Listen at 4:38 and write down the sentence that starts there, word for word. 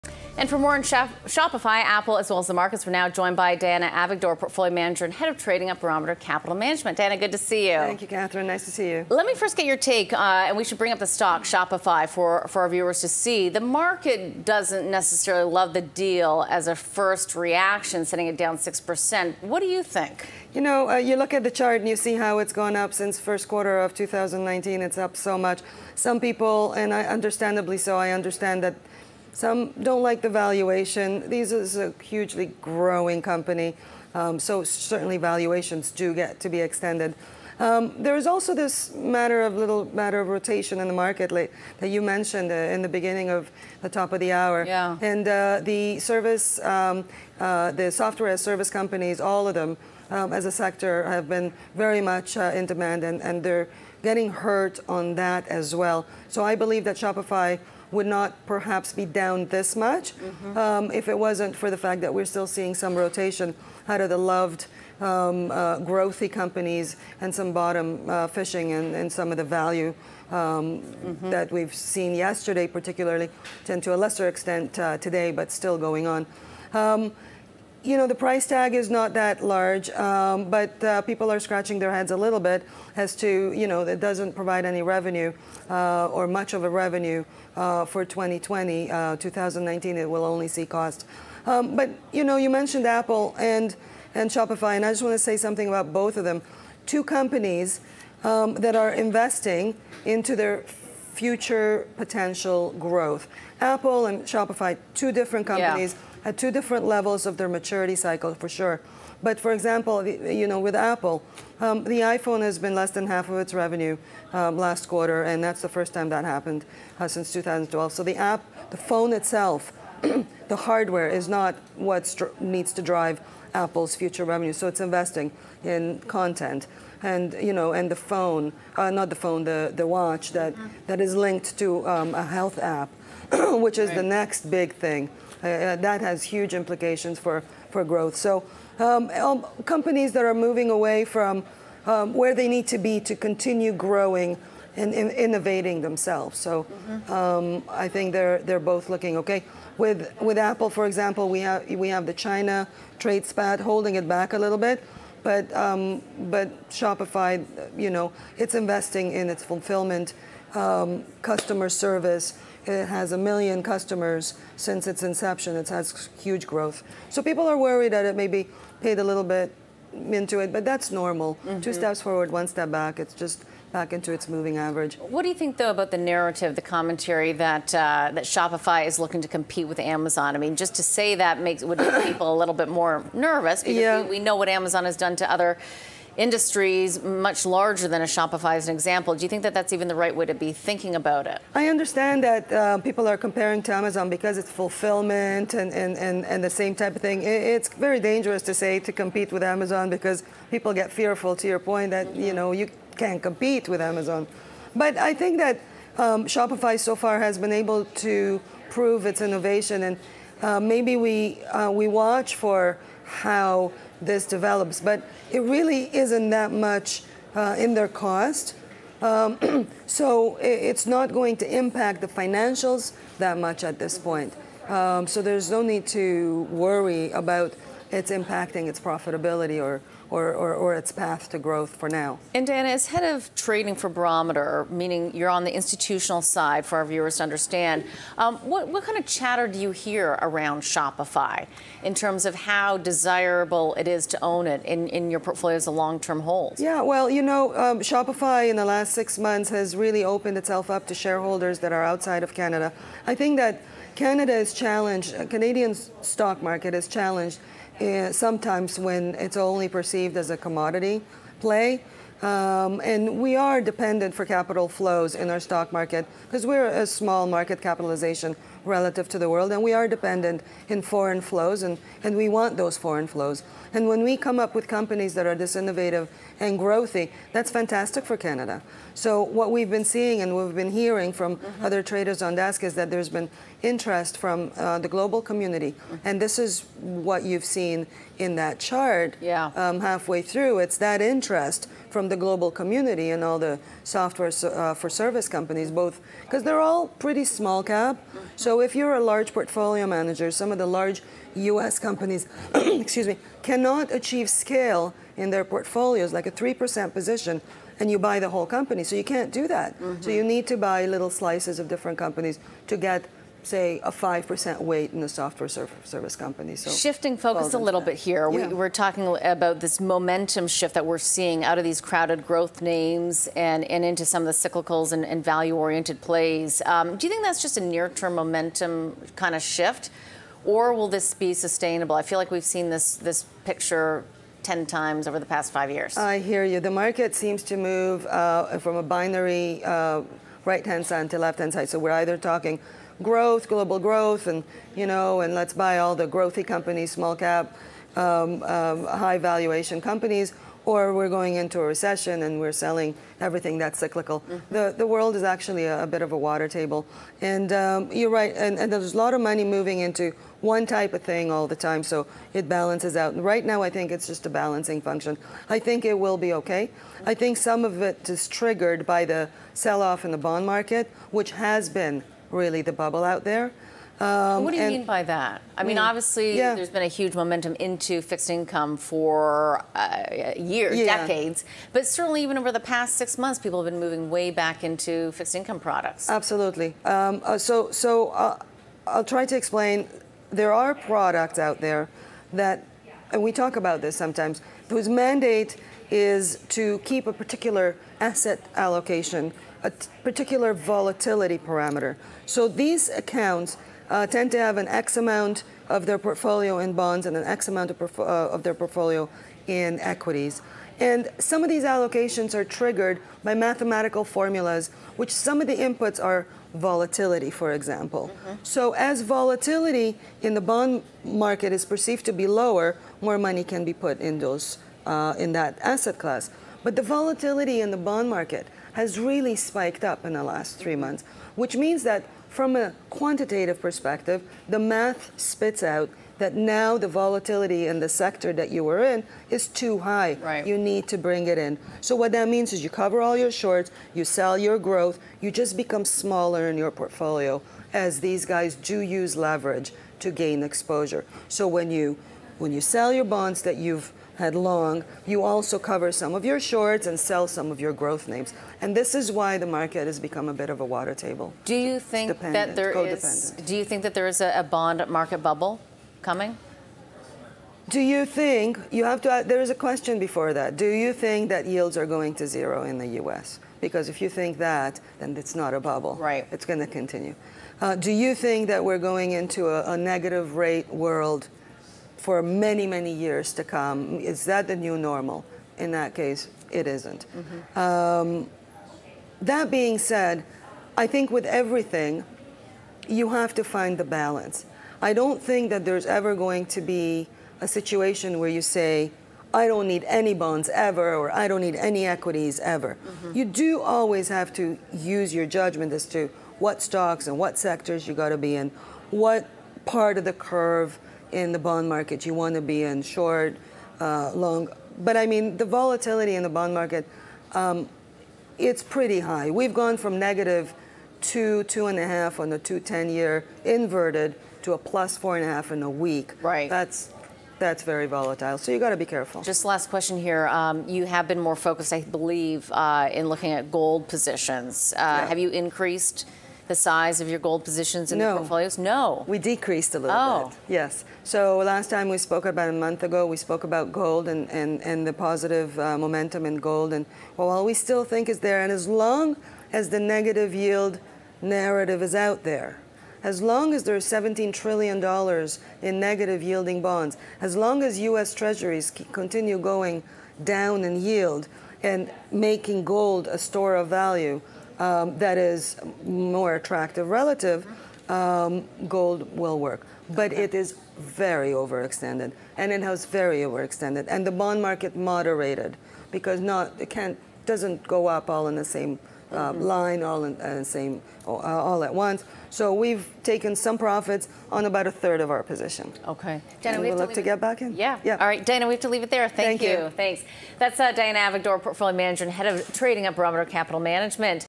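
So what we've been seeing and we've been hearing from mm-hmm.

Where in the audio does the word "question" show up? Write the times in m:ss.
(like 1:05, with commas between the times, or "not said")
7:49, 8:49.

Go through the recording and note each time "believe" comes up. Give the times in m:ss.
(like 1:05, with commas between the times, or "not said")
0:56, 8:51.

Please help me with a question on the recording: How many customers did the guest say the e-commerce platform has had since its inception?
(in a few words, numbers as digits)
a million.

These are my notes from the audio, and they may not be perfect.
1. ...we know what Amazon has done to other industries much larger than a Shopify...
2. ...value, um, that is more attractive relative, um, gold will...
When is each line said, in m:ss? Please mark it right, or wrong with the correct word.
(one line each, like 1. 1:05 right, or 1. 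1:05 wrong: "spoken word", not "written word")
1. 3:04 right
2. 9:23 right.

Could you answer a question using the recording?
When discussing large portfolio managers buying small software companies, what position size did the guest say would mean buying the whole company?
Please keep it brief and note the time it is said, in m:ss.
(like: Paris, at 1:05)
3%, at 5:06.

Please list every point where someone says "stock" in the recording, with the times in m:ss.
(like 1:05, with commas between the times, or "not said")
0:11, 4:15, 4:25, 8:26.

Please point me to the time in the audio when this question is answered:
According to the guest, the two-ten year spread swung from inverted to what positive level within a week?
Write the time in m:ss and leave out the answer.
8:44.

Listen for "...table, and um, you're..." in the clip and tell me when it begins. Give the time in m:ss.
5:56.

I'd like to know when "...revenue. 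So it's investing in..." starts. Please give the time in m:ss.
2:04.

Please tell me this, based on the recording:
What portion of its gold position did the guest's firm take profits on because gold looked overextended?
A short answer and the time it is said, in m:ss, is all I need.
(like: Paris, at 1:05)
a third, at 9:44.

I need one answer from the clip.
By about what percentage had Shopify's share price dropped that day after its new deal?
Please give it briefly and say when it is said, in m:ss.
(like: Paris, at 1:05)
6%, at 0:18.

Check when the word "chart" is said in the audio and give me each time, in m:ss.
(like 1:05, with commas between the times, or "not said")
0:21, 4:48.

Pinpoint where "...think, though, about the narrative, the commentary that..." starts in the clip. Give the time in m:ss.
2:55.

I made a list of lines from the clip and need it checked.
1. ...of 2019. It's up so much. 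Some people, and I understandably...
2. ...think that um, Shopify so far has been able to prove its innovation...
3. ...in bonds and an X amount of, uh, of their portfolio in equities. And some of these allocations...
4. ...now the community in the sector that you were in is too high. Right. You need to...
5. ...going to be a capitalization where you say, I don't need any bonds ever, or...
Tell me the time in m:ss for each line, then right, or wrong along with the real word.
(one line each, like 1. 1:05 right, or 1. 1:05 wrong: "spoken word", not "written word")
1. 0:23 right
2. 3:25 right
3. 6:46 right
4. 7:16 wrong: "volatility", not "community"
5. 8:16 wrong: "situation", not "capitalization".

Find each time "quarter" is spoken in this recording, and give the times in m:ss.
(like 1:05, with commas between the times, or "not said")
0:23, 1:54.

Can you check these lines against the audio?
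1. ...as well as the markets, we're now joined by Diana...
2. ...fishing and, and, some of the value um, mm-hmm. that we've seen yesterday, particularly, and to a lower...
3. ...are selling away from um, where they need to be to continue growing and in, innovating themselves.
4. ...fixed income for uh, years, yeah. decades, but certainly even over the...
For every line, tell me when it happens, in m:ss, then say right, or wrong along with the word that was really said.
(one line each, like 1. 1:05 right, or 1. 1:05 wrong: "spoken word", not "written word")
1. 0:02 right
2. 1:08 wrong: "lesser", not "lower"
3. 2:20 wrong: "moving", not "selling"
4. 6:18 right.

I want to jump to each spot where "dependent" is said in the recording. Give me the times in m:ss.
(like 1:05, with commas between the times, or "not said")
4:23, 4:29.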